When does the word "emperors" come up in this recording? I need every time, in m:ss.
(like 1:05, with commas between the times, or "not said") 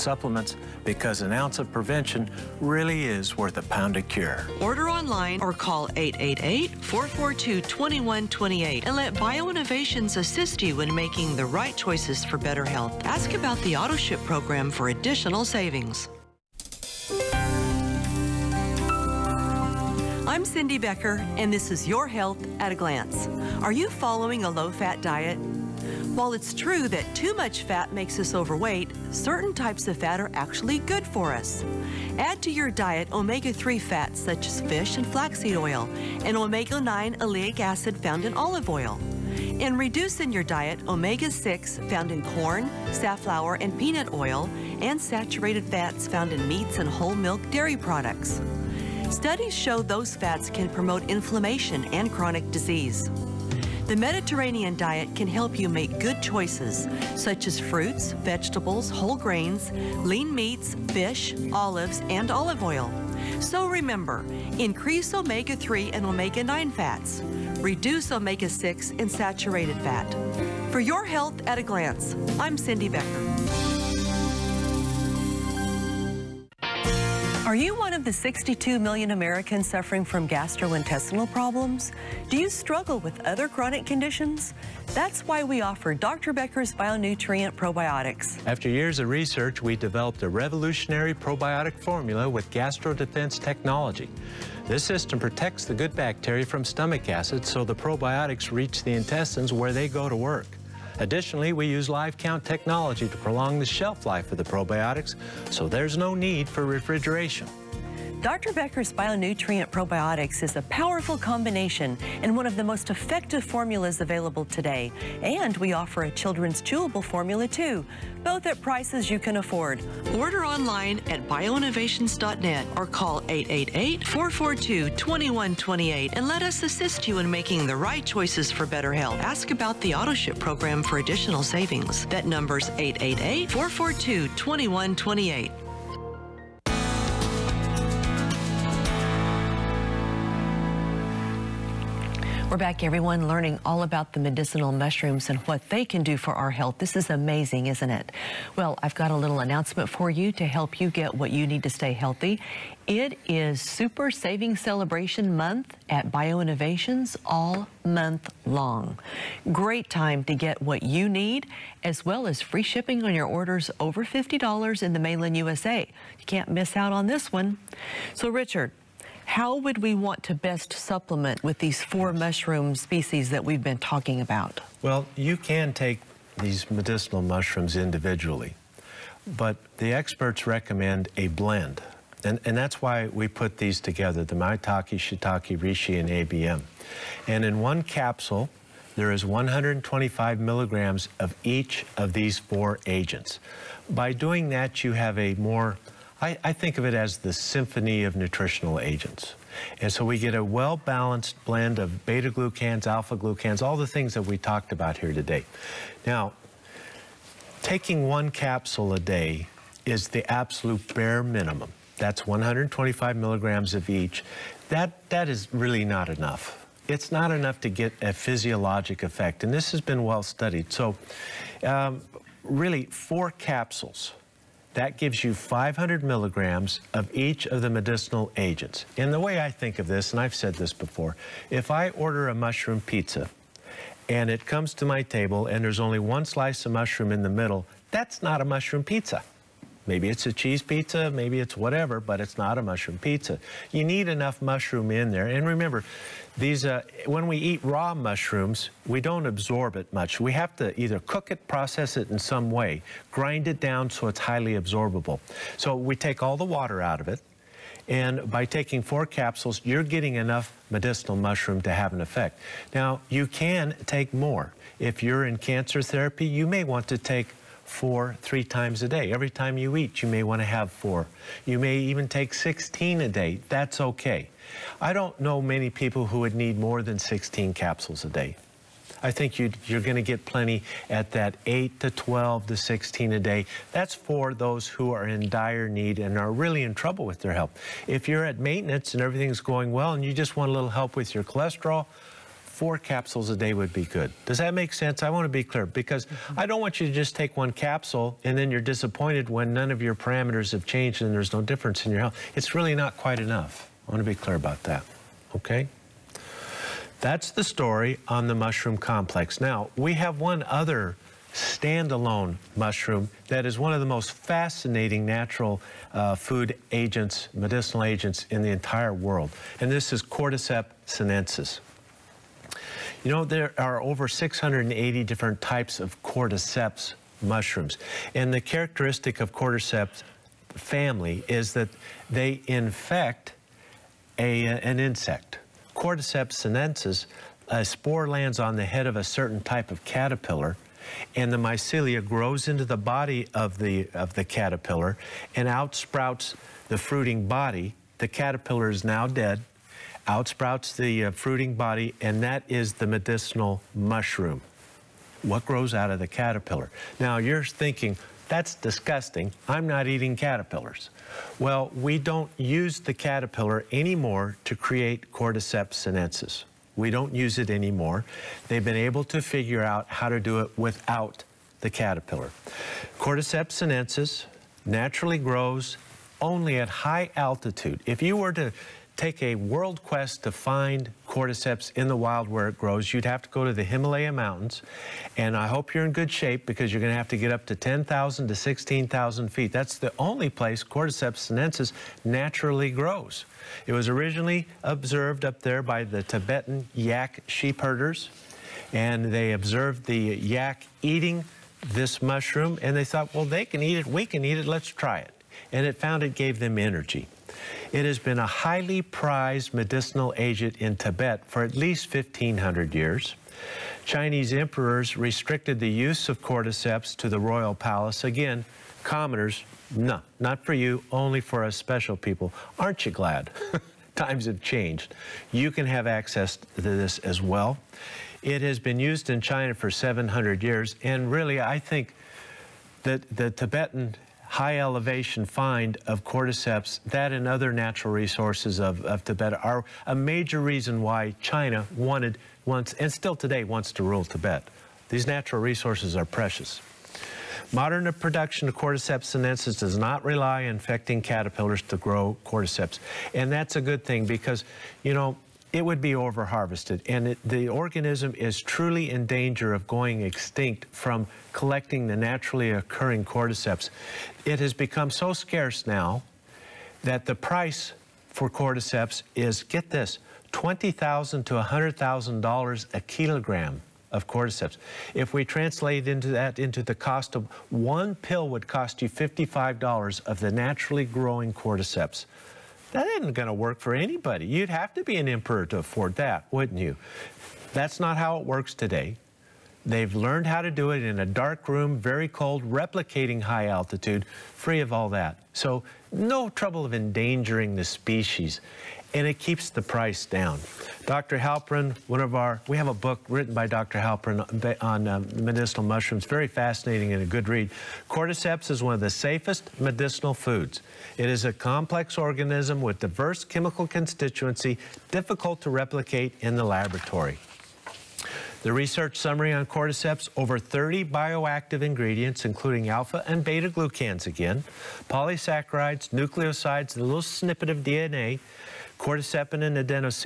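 6:54, 8:05.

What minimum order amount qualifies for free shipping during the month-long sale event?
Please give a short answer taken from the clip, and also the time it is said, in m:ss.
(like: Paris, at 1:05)
$50, at 2:44.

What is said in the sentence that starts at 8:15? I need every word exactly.
So no trouble of endangering the species and it keeps the price down.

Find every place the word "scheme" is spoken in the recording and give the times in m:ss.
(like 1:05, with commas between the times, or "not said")
not said.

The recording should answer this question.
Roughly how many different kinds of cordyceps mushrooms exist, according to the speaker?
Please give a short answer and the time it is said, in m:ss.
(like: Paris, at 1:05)
680, at 5:24.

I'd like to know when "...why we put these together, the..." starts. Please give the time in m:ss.
3:02.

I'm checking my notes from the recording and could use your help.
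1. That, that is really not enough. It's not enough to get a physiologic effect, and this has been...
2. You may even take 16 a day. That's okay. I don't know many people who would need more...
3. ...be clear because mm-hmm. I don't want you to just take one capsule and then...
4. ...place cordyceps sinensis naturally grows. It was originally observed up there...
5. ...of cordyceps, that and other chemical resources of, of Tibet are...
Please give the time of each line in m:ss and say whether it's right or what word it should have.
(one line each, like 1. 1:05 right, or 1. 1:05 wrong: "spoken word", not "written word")
1. 3:34 right
2. 4:31 right
3. 4:55 right
4. 6:30 right
5. 7:15 wrong: "natural", not "chemical".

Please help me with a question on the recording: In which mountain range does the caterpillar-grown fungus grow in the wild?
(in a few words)
Himalaya Mountains.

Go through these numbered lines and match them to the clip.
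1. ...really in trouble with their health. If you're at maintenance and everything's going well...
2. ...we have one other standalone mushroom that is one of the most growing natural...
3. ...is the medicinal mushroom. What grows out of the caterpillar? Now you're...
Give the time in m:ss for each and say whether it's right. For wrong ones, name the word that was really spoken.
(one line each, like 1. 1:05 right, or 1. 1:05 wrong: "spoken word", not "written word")
1. 4:46 right
2. 5:09 wrong: "fascinating", not "growing"
3. 5:52 right.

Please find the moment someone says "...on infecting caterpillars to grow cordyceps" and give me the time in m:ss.
7:30.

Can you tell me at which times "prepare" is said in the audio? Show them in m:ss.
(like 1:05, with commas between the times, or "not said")
not said.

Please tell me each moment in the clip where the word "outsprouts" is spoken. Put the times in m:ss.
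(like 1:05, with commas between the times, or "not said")
5:45, 5:50.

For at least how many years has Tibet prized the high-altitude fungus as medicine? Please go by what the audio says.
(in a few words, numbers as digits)
1,500 years.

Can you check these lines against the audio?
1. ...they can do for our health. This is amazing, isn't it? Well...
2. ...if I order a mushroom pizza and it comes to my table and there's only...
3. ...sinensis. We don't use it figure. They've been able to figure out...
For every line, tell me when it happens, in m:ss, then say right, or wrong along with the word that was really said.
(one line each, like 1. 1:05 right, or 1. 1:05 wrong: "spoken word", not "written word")
1. 2:25 right
2. 3:51 right
3. 6:05 wrong: "anymore", not "figure".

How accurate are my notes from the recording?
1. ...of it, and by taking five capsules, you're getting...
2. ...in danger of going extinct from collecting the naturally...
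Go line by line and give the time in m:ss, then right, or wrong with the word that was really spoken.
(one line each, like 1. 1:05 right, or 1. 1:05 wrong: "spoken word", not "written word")
1. 4:17 wrong: "four", not "five"
2. 7:38 right.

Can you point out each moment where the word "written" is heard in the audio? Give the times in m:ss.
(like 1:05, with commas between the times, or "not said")
8:23.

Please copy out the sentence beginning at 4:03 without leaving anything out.
You need enough mushroom in there.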